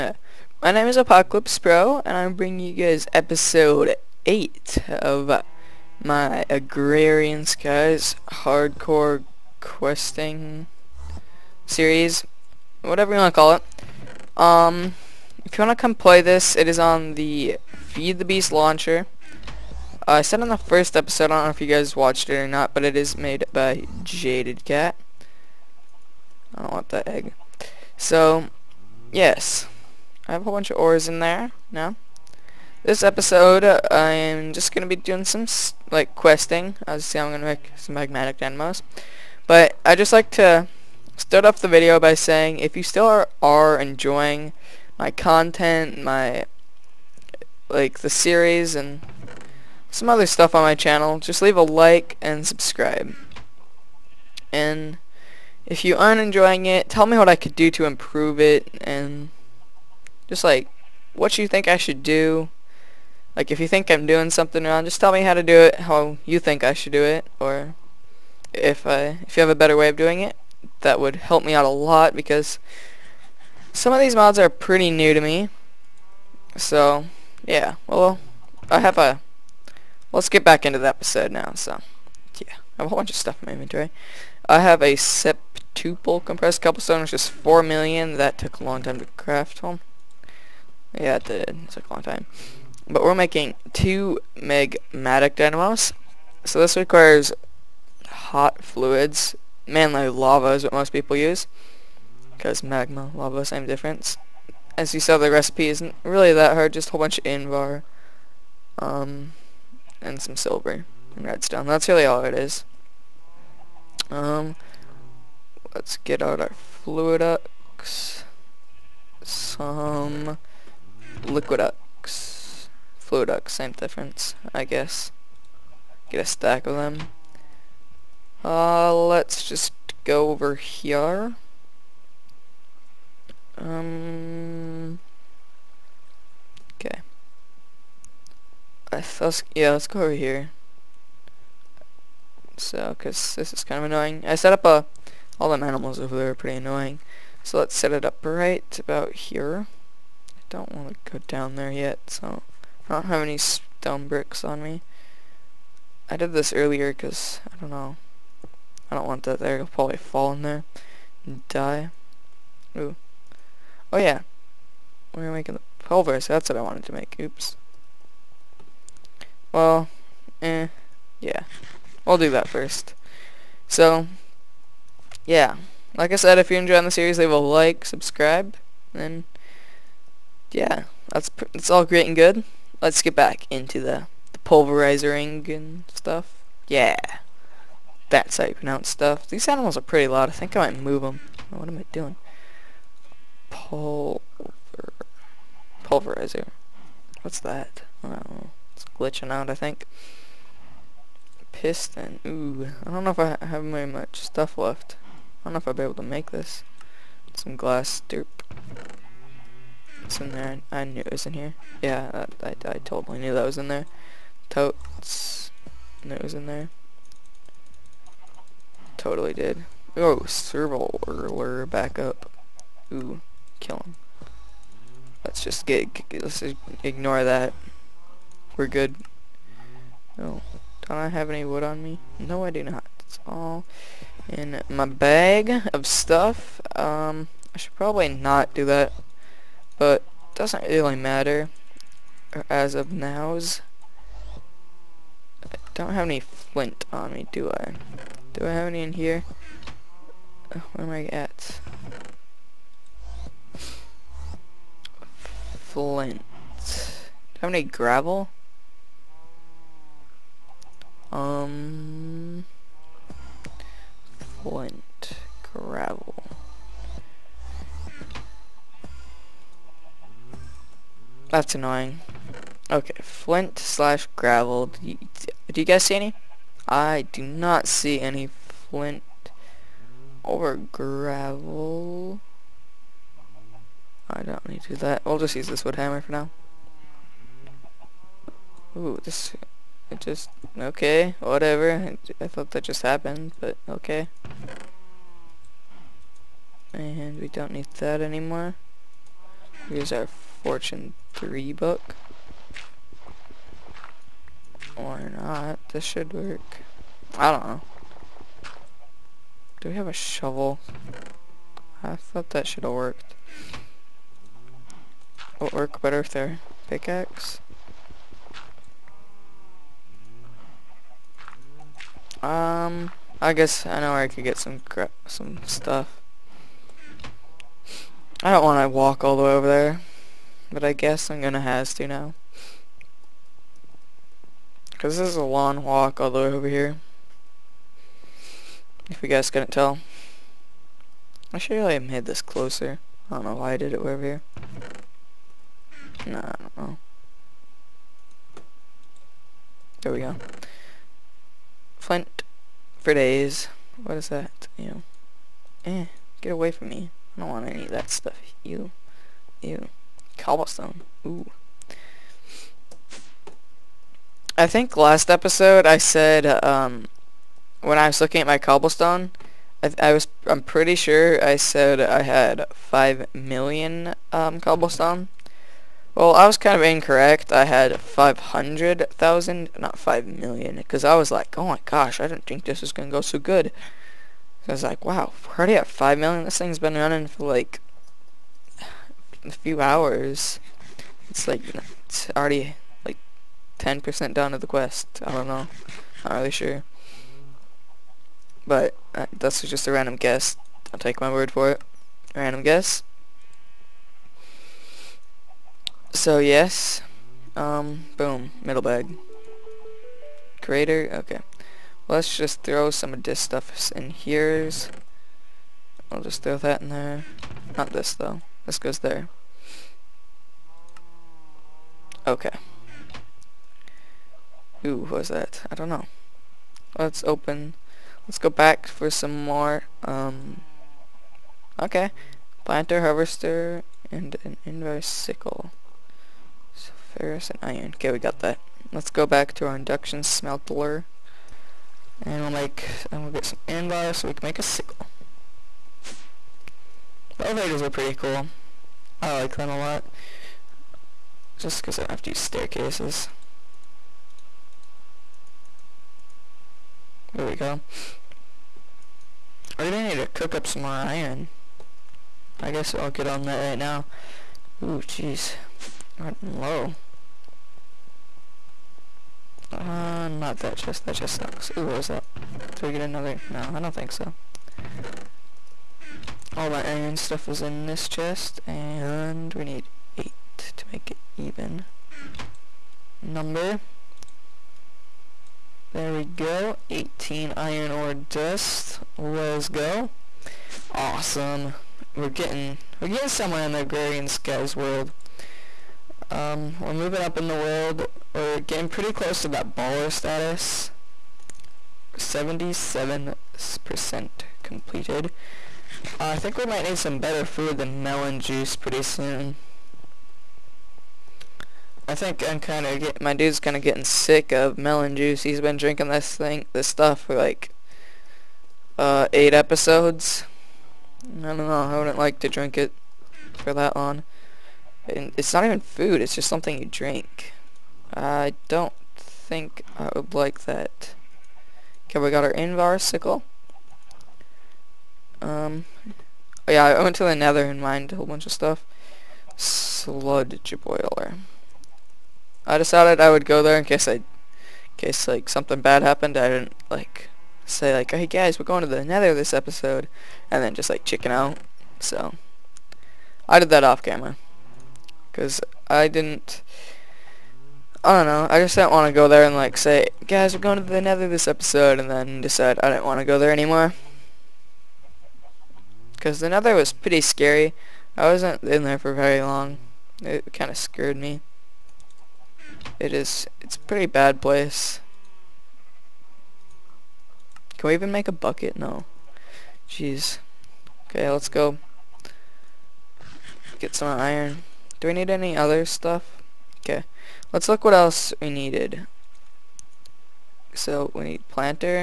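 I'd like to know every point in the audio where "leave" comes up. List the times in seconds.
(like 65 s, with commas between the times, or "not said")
51 s, 177 s.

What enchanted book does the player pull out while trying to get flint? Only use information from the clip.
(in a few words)
Fortune 3.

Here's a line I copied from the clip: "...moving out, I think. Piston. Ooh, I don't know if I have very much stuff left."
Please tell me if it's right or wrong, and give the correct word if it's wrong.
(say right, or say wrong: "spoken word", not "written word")
wrong: "glitching", not "moving".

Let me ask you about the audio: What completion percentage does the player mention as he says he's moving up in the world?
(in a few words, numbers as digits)
77%.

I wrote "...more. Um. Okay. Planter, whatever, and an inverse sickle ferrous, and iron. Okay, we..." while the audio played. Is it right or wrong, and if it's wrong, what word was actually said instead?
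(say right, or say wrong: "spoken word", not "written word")
wrong: "harvester", not "whatever".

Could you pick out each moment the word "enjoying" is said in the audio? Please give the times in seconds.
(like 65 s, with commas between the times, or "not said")
43 s, 56 s, 176 s.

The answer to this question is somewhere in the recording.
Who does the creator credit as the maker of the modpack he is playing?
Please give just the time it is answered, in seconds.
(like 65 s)
24 s.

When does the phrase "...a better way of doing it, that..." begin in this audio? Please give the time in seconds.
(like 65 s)
69 s.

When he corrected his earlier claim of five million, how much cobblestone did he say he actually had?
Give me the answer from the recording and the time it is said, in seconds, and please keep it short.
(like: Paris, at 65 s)
500,000, at 377 s.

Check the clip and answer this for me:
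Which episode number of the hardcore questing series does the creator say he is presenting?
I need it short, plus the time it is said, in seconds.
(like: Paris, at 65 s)
8, at 3 s.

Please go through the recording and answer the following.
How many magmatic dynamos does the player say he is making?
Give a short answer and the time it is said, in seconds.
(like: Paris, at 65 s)
2, at 93 s.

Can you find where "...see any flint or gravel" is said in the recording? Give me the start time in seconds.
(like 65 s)
277 s.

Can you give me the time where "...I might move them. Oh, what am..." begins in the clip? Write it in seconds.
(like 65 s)
190 s.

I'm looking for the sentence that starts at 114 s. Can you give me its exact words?
Um, Let's get out our Fluiducts.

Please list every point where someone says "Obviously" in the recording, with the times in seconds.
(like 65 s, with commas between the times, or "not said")
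36 s.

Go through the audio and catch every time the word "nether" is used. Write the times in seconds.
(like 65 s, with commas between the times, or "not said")
537 s, 548 s, 560 s, 566 s.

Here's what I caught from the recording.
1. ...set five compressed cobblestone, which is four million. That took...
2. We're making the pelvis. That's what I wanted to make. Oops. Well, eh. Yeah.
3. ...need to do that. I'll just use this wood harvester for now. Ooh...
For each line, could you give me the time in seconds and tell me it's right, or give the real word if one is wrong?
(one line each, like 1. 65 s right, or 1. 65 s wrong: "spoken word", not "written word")
1. 84 s wrong: "two", not "five"
2. 165 s right
3. 284 s wrong: "hammer", not "harvester".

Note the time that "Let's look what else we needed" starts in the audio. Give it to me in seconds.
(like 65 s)
587 s.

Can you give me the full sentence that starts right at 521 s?
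I wouldn't like to drink it for that long.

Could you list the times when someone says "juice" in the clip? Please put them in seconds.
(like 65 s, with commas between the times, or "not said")
508 s, 514 s.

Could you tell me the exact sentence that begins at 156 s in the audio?
I did this earlier because, I don't know, I don't want that there.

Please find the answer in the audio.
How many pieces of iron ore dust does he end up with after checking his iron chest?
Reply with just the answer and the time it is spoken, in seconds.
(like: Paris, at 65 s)
18, at 486 s.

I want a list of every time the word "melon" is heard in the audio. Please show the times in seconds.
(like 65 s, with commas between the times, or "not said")
507 s, 514 s.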